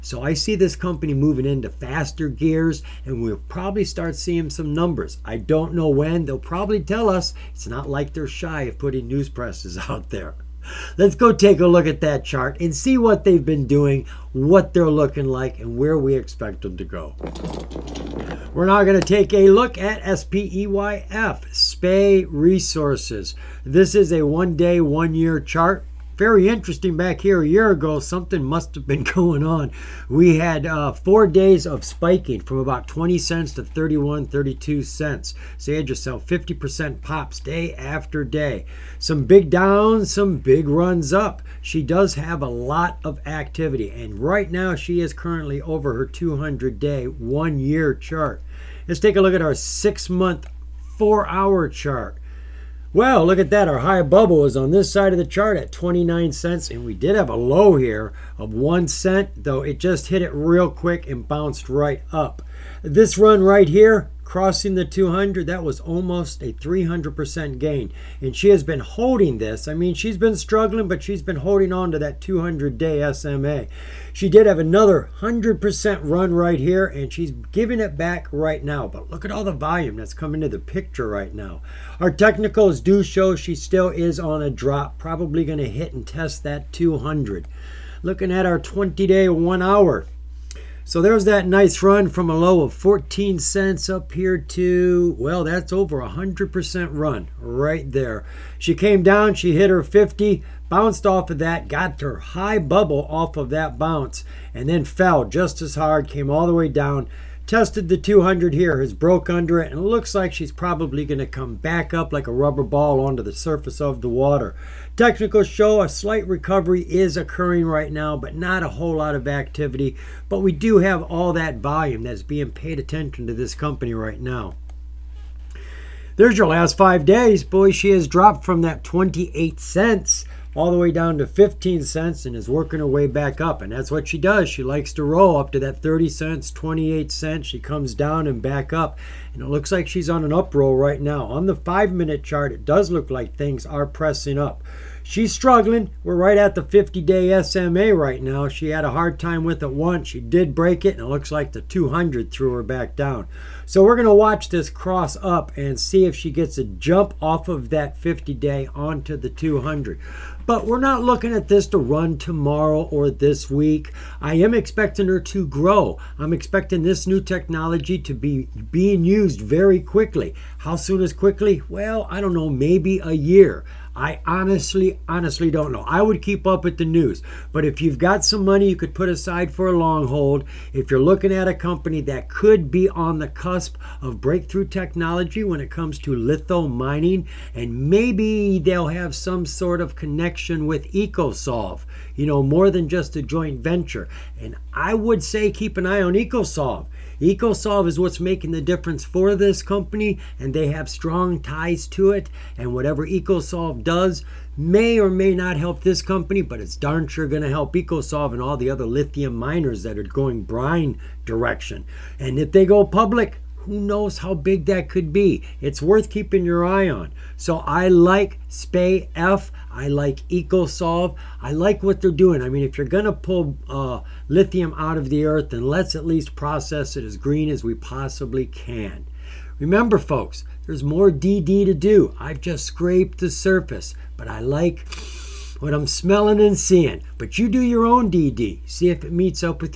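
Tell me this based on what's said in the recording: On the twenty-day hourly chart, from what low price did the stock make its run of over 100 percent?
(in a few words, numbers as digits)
14 cents.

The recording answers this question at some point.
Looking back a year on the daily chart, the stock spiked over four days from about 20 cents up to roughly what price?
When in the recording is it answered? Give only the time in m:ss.
0:33.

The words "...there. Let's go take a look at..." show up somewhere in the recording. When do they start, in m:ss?
0:10.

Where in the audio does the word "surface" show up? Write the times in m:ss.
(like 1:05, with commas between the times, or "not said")
1:53, 3:53.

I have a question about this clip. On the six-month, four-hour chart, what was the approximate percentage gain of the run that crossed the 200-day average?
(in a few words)
300%.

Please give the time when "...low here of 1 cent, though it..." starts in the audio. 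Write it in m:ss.
0:57.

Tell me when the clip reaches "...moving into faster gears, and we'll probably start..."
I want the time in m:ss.
0:01.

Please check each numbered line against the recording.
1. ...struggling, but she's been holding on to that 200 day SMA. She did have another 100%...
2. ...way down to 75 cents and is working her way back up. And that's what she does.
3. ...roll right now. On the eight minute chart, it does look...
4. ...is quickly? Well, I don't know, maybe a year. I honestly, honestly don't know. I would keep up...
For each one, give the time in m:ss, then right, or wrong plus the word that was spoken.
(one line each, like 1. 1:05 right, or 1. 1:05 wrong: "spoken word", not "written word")
1. 1:10 right
2. 2:10 wrong: "15", not "75"
3. 2:20 wrong: "five", not "eight"
4. 2:51 right.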